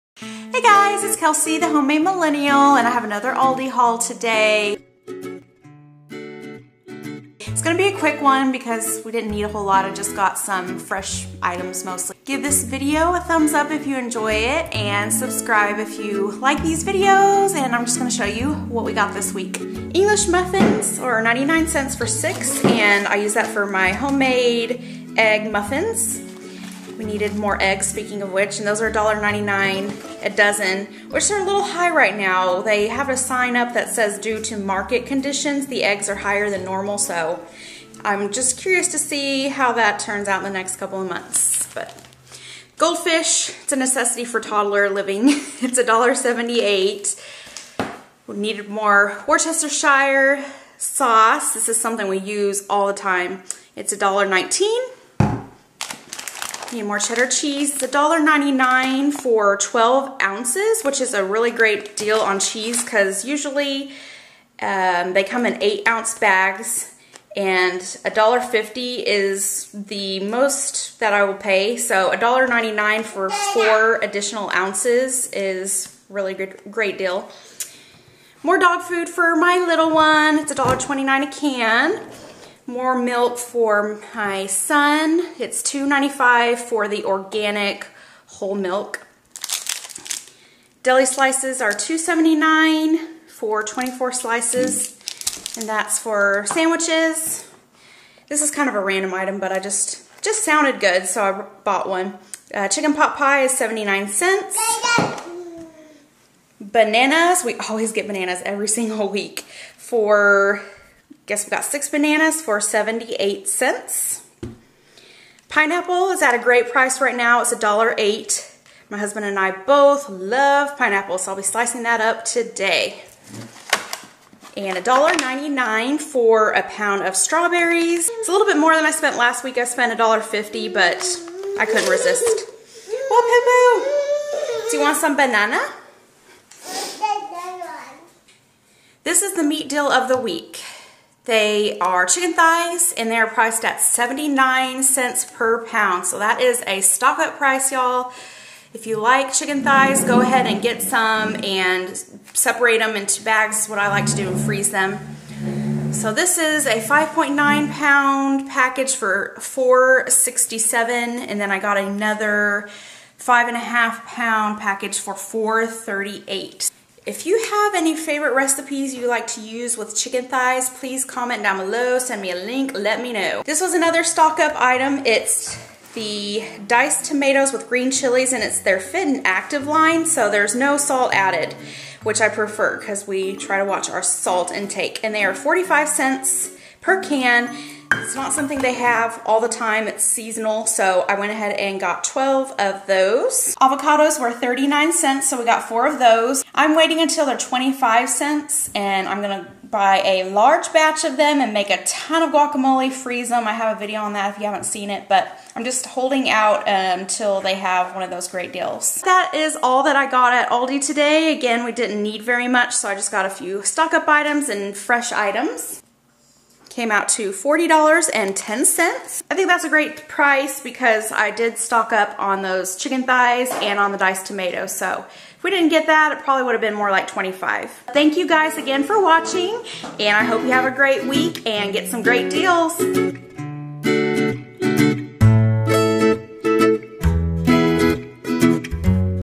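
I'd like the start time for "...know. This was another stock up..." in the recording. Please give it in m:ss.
2:53.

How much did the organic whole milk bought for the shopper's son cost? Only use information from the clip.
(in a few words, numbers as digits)
$2.95.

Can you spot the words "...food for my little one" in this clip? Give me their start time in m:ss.
1:18.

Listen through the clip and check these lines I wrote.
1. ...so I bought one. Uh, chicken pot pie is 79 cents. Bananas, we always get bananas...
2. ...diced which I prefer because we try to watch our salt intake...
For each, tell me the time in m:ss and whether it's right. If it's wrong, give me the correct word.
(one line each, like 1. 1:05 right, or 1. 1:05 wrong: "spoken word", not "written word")
1. 1:41 right
2. 3:01 wrong: "added", not "diced".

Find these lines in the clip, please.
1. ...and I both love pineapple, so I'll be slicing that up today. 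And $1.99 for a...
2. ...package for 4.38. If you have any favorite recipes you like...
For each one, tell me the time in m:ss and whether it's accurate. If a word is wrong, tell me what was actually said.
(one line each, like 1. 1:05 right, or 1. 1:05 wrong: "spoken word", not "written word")
1. 1:59 right
2. 2:44 right.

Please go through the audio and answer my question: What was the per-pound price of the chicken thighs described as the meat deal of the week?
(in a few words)
79 cents.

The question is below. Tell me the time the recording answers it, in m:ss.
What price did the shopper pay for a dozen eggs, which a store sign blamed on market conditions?
0:28.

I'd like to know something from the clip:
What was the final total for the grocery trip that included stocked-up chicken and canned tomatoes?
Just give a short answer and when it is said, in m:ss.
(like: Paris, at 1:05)
$40.10, at 3:37.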